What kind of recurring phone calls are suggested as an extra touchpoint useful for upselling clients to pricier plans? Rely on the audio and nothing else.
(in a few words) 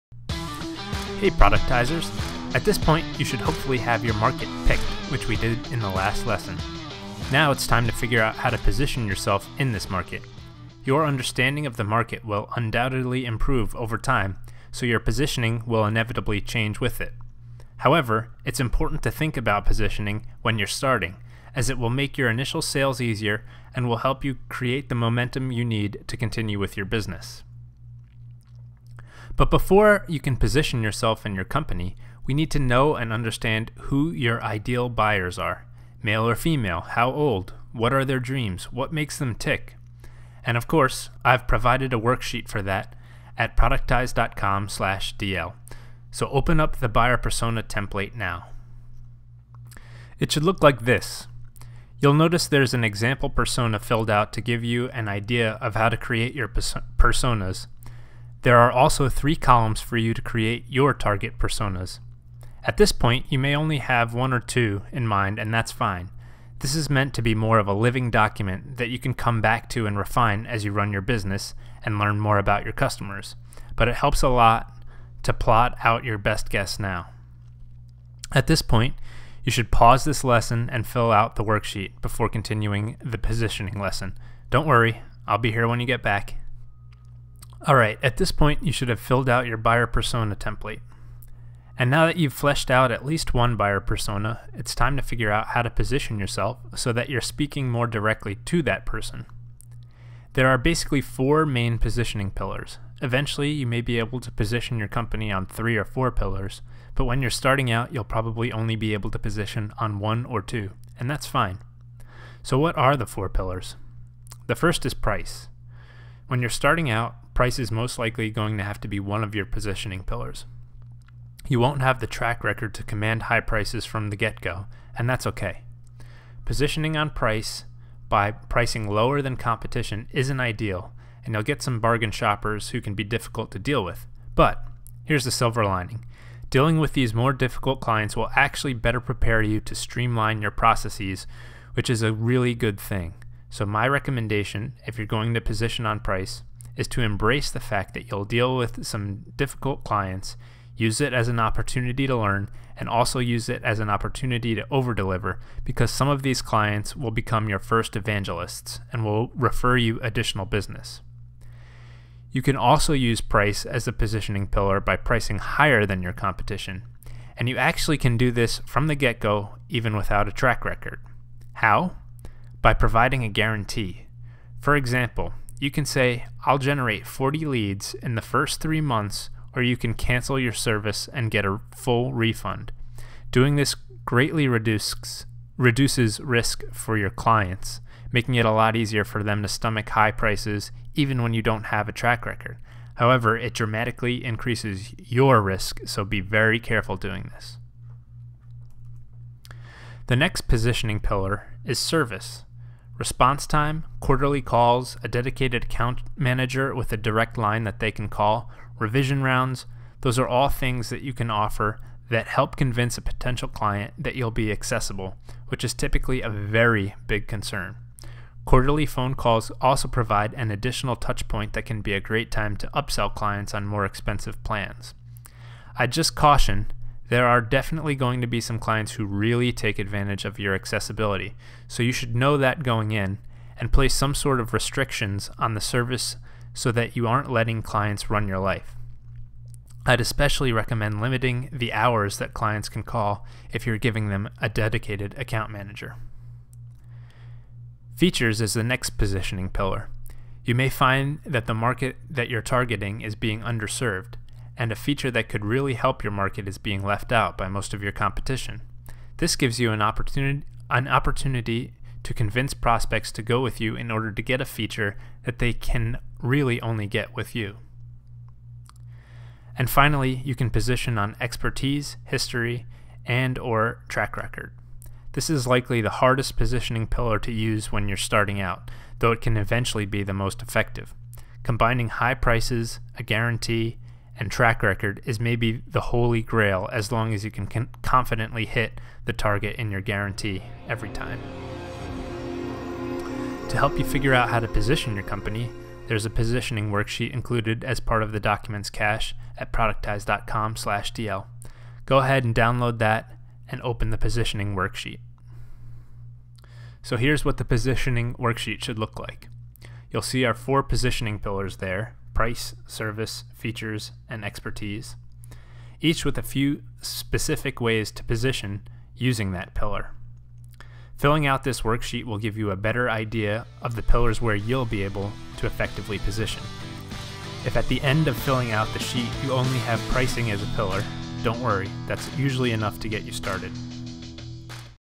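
Quarterly calls.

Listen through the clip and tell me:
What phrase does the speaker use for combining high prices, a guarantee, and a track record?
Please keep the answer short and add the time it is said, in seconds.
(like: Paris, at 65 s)
the holy grail, at 285 s.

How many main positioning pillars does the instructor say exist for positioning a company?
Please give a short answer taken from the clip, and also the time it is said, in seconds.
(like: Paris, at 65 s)
4, at 101 s.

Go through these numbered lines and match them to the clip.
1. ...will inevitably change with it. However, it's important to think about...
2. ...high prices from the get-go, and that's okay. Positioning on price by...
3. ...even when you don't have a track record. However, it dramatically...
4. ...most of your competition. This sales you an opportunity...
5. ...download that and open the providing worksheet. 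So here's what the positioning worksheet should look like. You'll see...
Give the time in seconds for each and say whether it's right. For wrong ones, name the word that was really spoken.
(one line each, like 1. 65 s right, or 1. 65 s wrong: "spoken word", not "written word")
1. 15 s right
2. 123 s right
3. 190 s right
4. 257 s wrong: "gives", not "sales"
5. 302 s wrong: "positioning", not "providing".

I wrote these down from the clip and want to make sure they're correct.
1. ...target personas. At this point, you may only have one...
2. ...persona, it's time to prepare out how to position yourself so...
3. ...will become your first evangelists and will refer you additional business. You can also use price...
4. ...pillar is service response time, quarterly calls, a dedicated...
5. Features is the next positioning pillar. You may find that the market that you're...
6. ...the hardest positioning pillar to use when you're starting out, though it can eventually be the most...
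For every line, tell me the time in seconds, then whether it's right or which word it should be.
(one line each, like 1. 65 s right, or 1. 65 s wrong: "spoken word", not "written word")
1. 60 s right
2. 93 s wrong: "figure", not "prepare"
3. 156 s right
4. 201 s right
5. 247 s right
6. 275 s right.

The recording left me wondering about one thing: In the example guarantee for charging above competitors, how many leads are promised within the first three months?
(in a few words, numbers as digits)
40.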